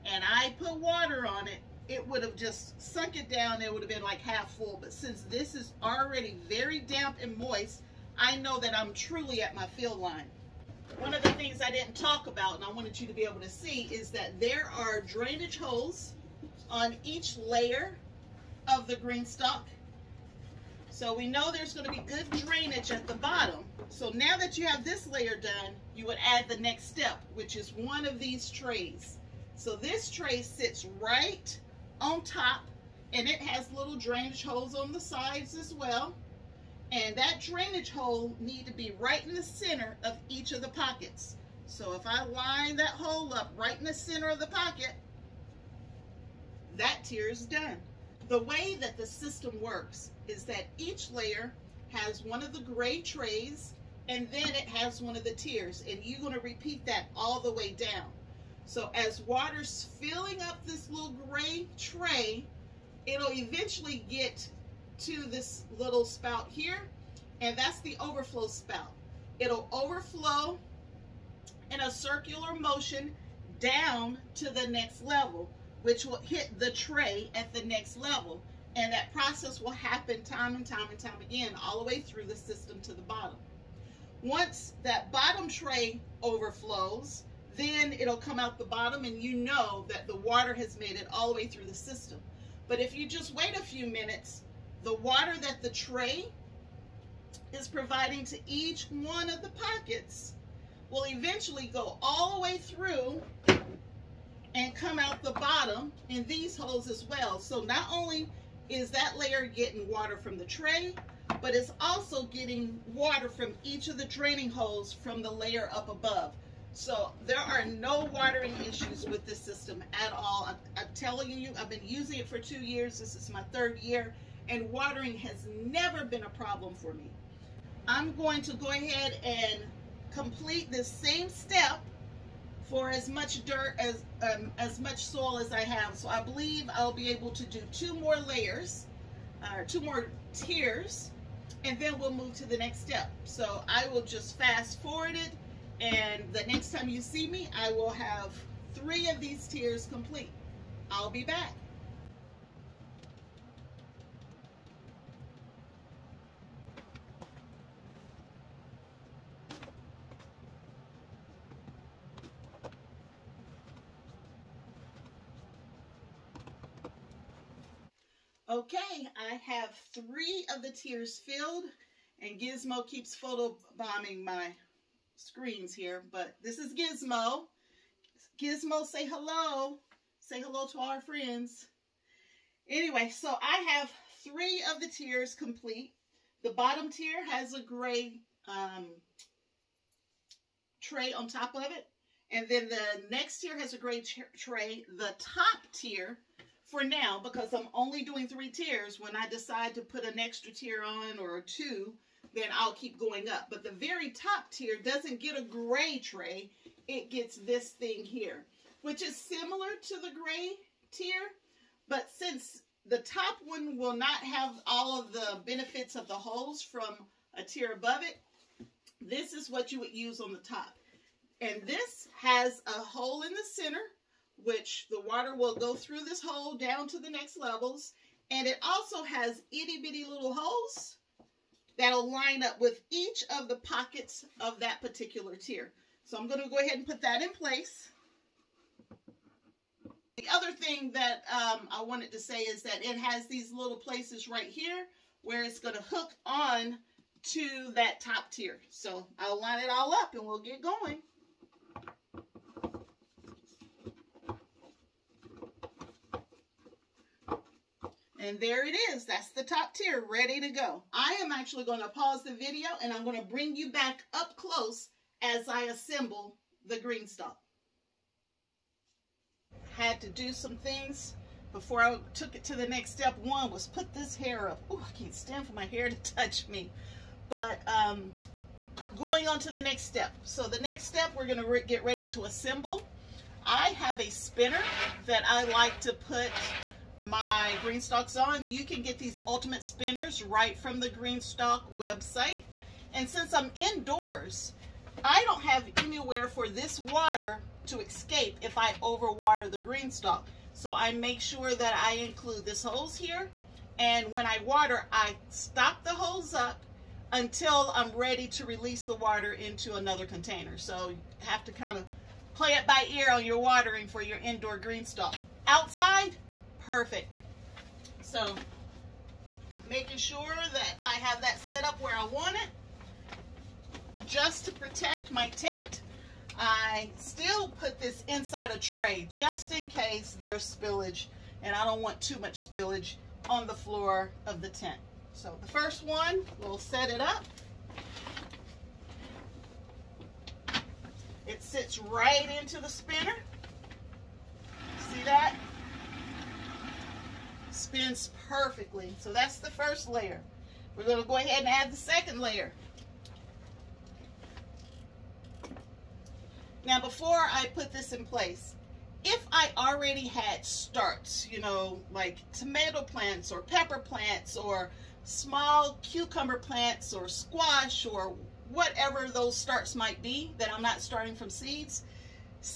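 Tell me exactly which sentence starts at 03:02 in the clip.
Anyway, so I have three of the tiers complete.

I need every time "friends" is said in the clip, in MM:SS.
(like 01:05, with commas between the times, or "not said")
03:01.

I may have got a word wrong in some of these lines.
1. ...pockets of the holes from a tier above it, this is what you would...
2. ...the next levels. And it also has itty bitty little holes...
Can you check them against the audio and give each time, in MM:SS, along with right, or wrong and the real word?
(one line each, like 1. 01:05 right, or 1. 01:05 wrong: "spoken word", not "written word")
1. 03:35 wrong: "benefits", not "pockets"
2. 03:46 right.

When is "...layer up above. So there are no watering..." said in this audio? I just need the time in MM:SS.
01:55.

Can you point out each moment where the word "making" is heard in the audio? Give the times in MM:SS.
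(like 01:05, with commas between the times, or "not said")
05:19.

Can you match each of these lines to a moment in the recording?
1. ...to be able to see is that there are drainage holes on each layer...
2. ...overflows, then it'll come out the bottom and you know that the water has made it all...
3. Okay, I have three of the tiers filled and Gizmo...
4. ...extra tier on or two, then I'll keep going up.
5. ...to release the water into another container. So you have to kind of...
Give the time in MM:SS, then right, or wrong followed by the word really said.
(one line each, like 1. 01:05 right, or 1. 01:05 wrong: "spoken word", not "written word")
1. 00:13 right
2. 01:26 right
3. 02:48 right
4. 03:20 right
5. 05:08 right.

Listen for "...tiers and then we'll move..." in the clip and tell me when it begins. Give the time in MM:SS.
02:20.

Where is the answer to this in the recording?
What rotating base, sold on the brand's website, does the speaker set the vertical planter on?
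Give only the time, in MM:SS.
04:49.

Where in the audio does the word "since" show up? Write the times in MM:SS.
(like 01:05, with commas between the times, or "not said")
00:04, 03:32, 04:53.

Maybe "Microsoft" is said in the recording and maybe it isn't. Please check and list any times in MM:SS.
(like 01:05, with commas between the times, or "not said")
not said.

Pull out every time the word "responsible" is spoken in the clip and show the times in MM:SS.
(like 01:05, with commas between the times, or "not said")
not said.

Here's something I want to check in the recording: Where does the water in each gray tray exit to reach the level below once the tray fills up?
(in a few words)
overflow spout.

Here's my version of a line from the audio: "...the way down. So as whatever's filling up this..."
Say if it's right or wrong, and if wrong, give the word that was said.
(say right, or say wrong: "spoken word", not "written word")
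wrong: "water", not "whatever".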